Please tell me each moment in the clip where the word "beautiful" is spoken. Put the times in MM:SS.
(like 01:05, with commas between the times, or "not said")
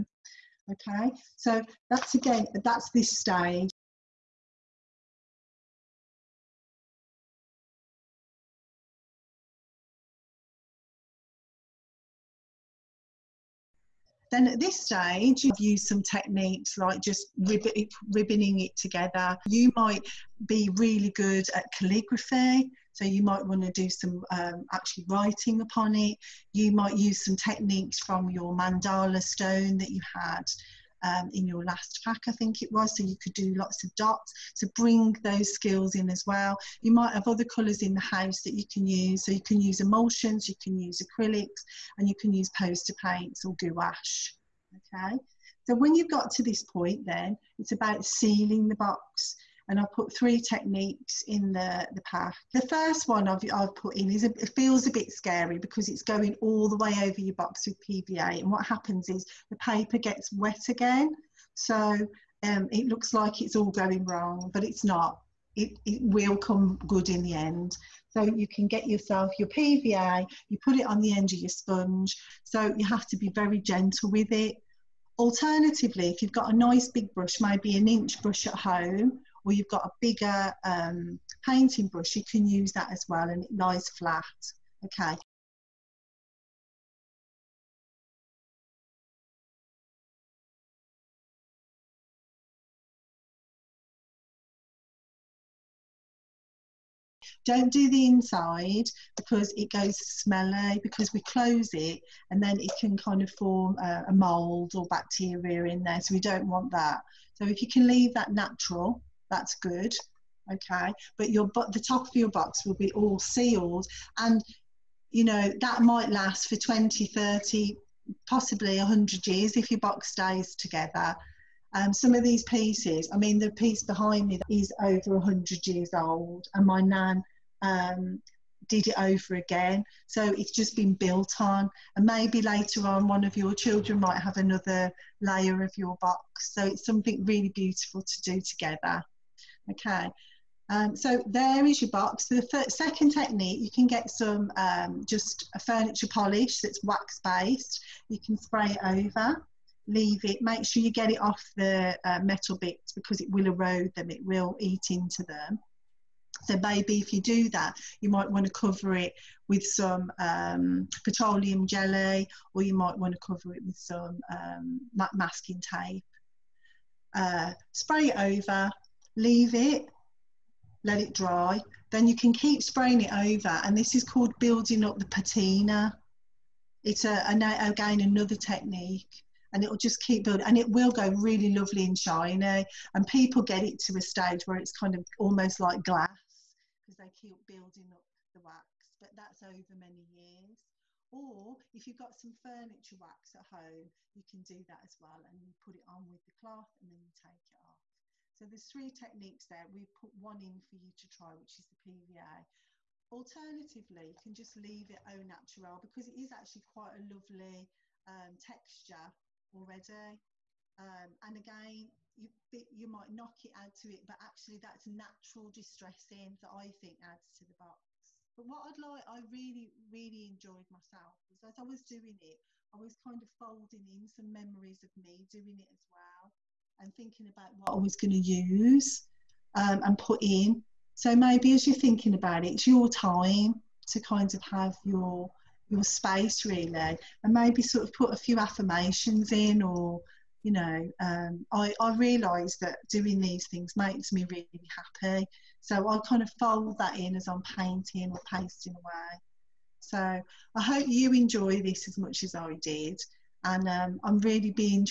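02:17.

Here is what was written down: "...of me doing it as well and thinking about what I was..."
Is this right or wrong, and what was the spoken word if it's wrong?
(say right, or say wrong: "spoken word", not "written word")
right.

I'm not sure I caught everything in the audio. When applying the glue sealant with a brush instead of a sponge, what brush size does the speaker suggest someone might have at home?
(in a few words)
an inch brush.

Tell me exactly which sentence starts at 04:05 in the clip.
So I kind of fold that in as I'm painting or pasting away.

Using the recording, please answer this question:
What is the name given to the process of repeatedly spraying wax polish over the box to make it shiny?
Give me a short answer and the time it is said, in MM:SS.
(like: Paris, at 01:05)
building up the patina, at 02:54.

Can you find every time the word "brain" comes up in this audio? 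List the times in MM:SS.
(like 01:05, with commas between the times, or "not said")
not said.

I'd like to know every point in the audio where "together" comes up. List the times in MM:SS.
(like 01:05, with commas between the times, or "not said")
00:18, 02:00, 02:18.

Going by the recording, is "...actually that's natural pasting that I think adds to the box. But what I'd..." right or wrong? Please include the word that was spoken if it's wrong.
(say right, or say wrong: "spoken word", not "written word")
wrong: "distressing", not "pasting".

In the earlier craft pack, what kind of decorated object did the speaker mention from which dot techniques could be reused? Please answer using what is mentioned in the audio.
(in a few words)
mandala stone.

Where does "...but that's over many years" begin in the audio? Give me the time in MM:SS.
03:08.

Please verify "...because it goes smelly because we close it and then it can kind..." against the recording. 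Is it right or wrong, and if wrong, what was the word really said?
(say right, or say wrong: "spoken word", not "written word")
right.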